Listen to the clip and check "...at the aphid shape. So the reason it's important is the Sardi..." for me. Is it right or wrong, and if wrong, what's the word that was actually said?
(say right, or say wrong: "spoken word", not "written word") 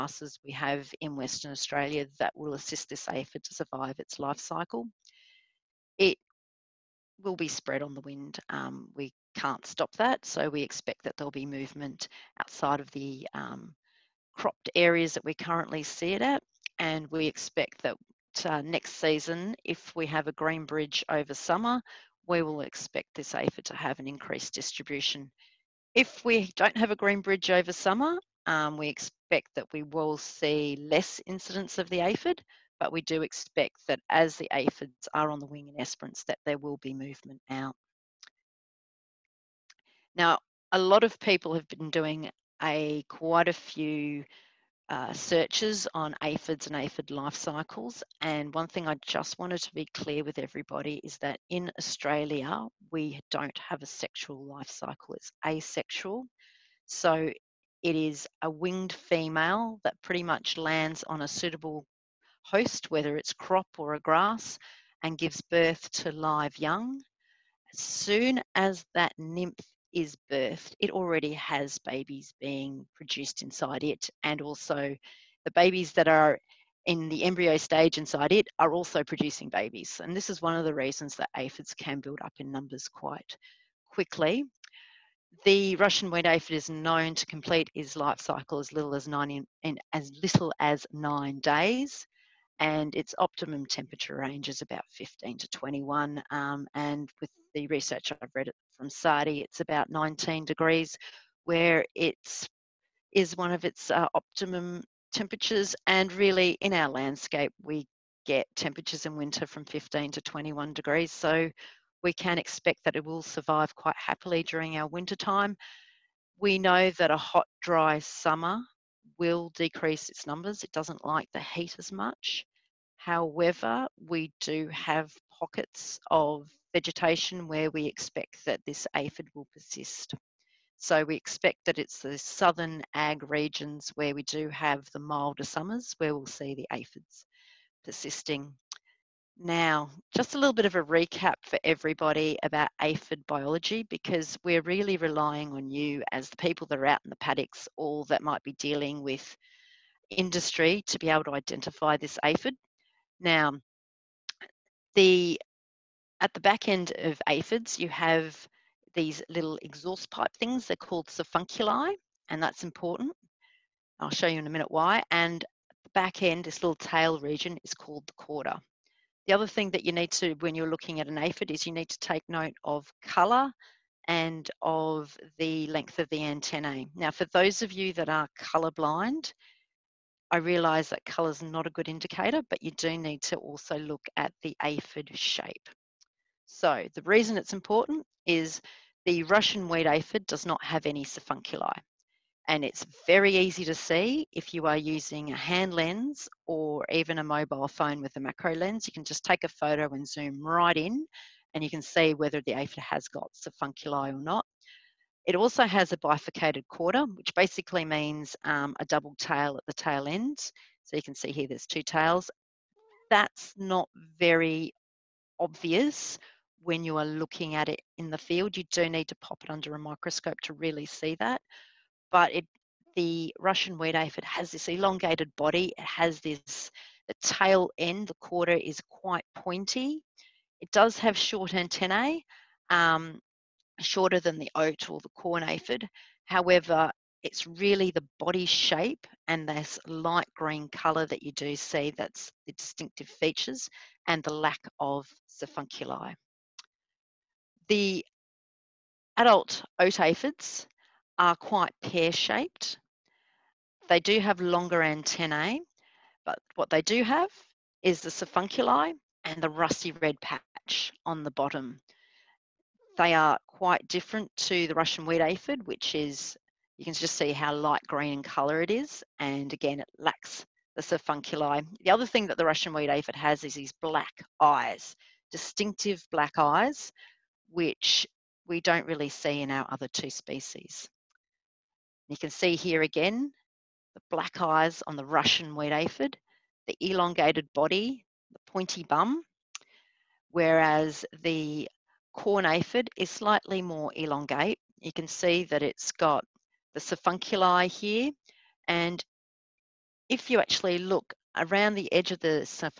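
wrong: "Russian", not "Sardi".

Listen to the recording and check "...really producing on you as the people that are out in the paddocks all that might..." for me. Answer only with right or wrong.
wrong.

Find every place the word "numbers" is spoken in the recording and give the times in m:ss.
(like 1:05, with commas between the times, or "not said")
1:22, 2:00.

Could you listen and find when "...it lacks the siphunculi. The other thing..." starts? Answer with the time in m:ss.
4:29.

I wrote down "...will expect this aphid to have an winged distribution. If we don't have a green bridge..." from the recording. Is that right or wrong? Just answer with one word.
wrong.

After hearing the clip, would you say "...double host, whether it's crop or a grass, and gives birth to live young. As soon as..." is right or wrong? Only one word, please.
wrong.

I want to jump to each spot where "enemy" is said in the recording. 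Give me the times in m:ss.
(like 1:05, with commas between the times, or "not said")
not said.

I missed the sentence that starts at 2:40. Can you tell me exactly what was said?
They're called siphunculi, and that's important.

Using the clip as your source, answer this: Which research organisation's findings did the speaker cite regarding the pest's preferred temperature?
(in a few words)
SARDI.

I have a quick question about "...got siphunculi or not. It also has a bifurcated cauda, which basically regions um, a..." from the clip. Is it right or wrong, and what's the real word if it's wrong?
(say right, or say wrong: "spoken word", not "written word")
wrong: "means", not "regions".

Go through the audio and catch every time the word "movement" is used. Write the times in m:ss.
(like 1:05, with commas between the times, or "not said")
0:11, 0:36.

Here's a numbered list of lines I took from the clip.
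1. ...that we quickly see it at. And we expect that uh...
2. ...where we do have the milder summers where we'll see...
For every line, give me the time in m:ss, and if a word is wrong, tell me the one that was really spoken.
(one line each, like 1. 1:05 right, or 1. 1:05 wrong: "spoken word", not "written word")
1. 0:15 wrong: "currently", not "quickly"
2. 2:13 right.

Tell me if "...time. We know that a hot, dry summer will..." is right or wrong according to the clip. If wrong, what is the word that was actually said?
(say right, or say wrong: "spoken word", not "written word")
right.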